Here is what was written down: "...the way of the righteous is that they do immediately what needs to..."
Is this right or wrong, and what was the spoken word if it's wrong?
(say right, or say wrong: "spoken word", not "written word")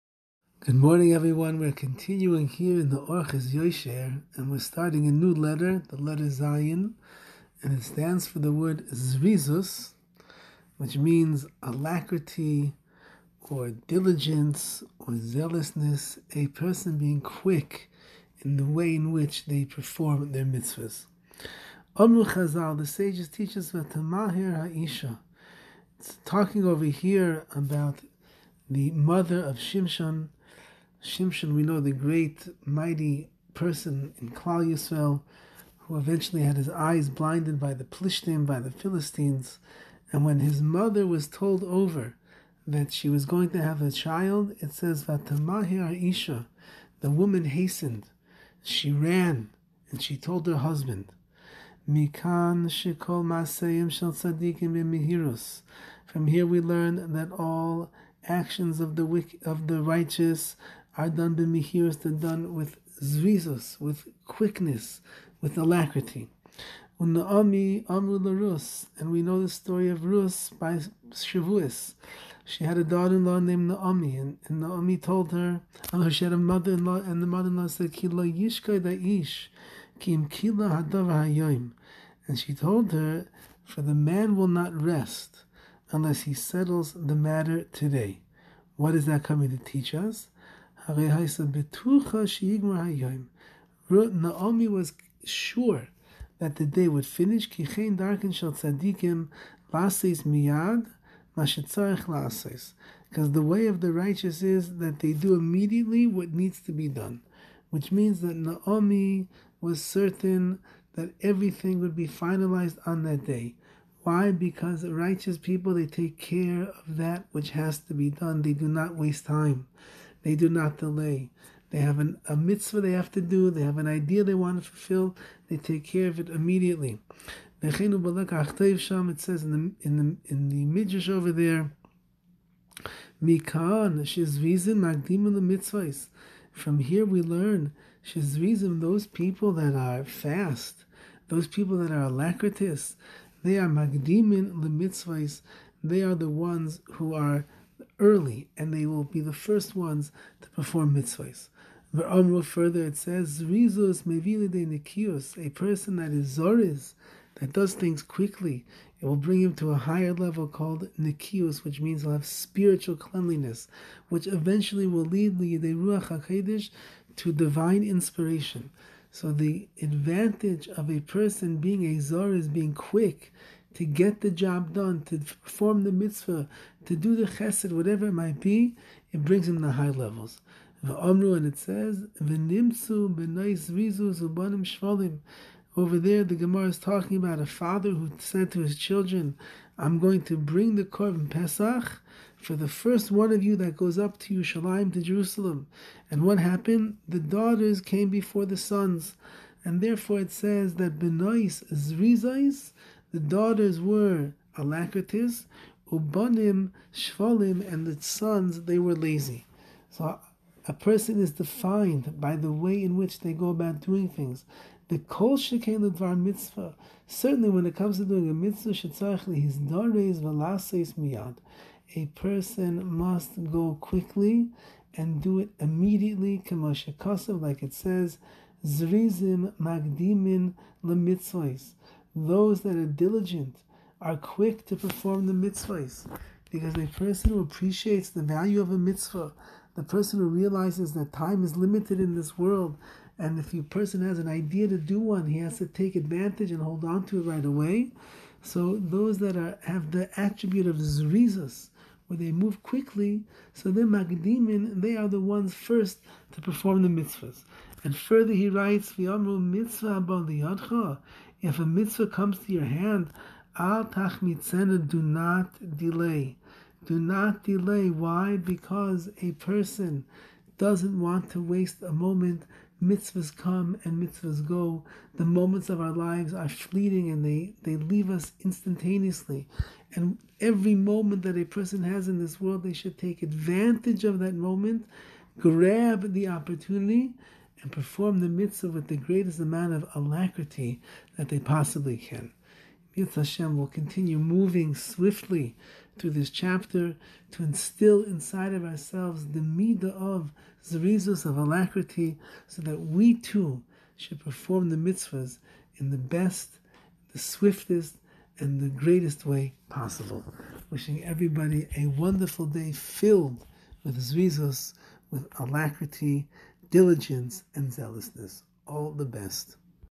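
right.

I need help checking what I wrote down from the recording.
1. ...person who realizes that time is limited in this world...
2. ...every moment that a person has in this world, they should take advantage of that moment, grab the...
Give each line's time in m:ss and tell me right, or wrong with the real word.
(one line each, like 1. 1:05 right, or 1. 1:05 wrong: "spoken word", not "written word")
1. 3:59 right
2. 4:40 right.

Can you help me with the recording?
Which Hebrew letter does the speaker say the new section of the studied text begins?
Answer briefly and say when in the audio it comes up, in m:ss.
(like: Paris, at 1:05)
Zayin, at 0:06.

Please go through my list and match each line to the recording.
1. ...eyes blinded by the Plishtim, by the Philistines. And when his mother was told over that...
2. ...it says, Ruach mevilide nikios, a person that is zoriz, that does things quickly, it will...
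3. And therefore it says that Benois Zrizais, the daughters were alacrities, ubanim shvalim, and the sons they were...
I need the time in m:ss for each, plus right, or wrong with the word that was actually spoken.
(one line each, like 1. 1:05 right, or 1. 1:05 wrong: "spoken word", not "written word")
1. 0:36 right
2. 2:32 wrong: "Rizos", not "Ruach"
3. 3:19 right.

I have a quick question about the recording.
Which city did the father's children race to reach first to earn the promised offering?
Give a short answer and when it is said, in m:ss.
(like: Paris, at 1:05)
Yerushalayim, at 3:14.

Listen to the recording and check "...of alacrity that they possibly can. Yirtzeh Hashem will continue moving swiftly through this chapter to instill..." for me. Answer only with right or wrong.
right.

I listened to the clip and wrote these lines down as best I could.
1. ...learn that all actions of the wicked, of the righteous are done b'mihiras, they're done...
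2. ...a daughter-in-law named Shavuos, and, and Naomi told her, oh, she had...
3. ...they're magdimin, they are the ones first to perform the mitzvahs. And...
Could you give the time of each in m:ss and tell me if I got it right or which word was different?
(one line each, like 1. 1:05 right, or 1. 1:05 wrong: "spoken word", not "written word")
1. 0:56 right
2. 1:12 wrong: "Naomi", not "Shavuos"
3. 4:13 right.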